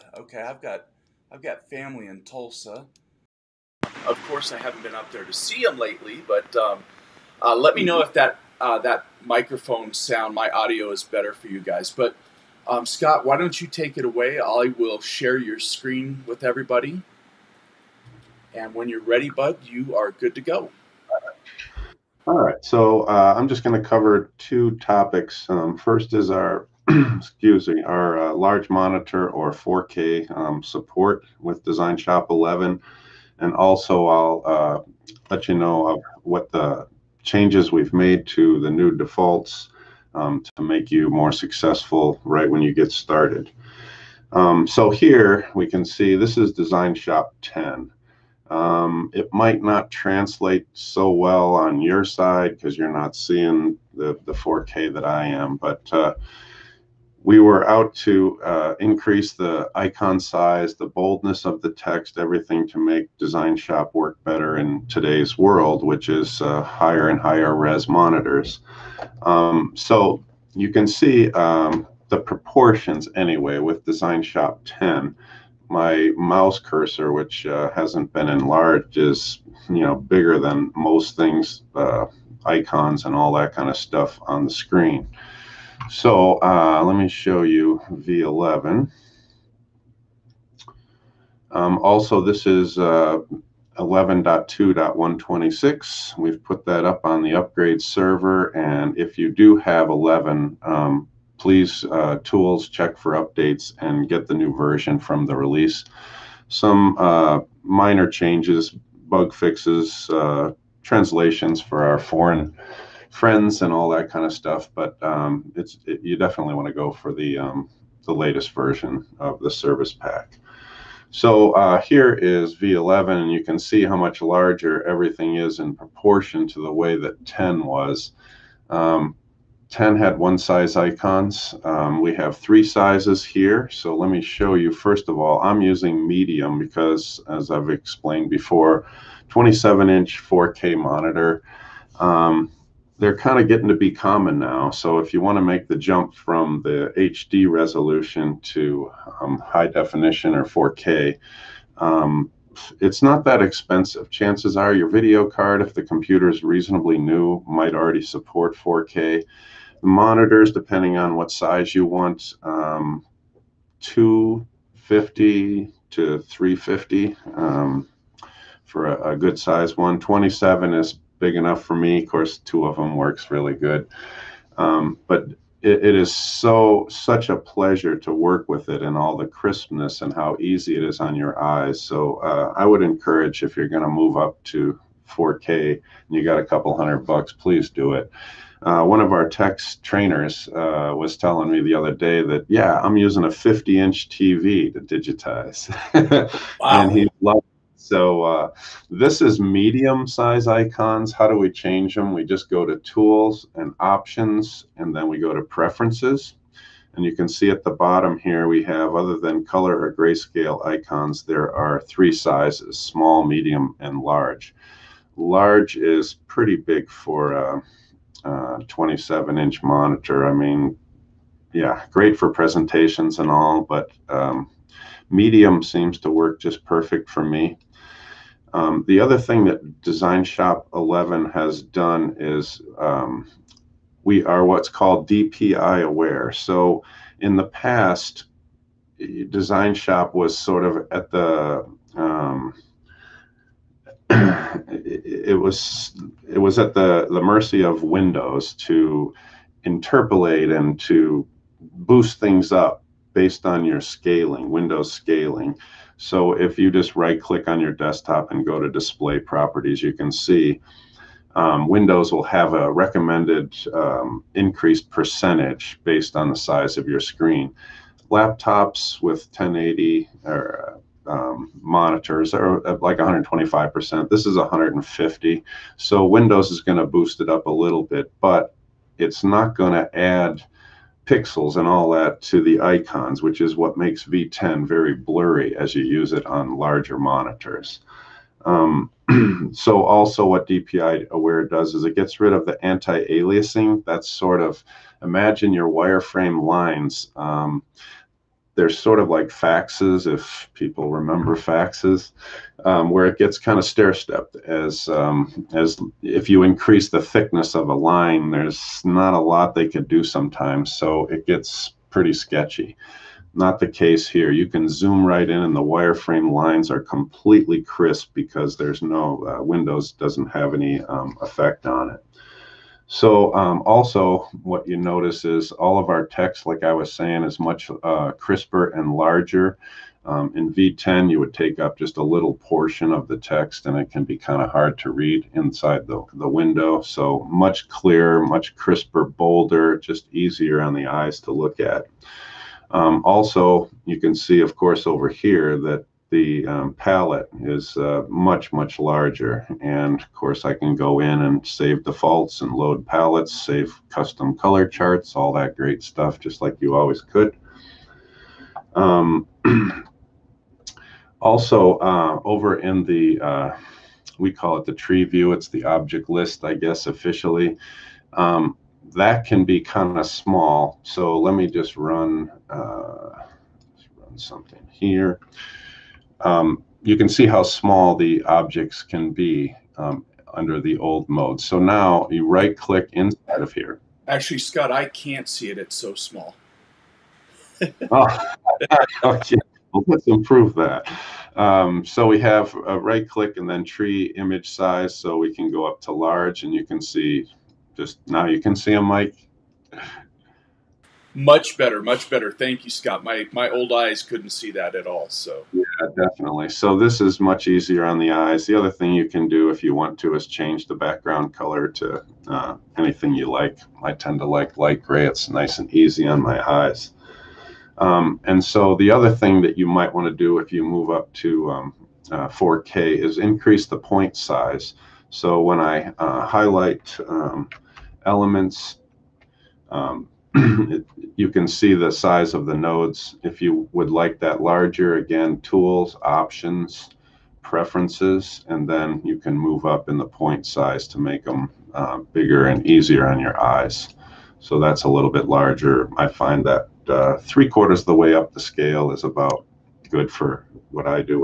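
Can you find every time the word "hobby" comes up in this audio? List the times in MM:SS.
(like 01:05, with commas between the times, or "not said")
not said.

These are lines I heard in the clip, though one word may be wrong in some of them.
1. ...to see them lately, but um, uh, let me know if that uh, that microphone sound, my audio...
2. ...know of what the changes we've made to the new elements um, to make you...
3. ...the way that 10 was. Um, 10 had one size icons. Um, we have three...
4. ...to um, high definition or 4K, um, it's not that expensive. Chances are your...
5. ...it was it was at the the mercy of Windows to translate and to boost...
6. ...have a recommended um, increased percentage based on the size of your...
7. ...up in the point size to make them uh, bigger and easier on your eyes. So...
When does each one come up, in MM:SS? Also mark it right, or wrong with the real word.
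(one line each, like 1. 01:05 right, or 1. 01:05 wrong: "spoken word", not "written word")
1. 00:05 right
2. 00:35 wrong: "defaults", not "elements"
3. 02:06 right
4. 02:28 right
5. 04:05 wrong: "interpolate", not "translate"
6. 04:22 right
7. 07:19 right.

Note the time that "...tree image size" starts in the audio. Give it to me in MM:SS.
06:33.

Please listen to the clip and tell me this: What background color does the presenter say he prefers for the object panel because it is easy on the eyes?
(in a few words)
Light gray.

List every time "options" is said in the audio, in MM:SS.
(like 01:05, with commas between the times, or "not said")
03:23, 07:16.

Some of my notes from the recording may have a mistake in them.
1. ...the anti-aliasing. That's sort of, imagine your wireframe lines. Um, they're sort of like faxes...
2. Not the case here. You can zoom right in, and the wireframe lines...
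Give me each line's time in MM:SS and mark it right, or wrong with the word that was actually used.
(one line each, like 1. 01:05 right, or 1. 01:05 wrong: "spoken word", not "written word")
1. 04:52 right
2. 05:13 right.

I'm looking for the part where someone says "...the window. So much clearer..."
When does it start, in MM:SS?
05:36.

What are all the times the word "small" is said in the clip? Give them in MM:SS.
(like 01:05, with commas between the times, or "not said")
03:32, 06:10, 06:17, 06:25.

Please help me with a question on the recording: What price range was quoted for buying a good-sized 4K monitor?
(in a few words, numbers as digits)
250 to 350.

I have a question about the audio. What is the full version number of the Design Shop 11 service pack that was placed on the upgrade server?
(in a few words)
11.2.126.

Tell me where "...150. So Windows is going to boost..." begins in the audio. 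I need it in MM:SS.
04:34.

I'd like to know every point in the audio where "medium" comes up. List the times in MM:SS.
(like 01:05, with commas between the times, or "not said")
02:16, 03:19, 03:33, 03:45.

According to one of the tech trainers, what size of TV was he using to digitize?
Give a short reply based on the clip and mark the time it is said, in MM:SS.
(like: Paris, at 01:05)
50 inch, at 03:13.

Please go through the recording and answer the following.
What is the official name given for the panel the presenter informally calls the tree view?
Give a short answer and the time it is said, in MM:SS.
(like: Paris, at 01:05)
Object list, at 06:05.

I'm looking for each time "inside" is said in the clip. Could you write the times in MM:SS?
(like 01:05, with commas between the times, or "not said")
05:35, 06:22.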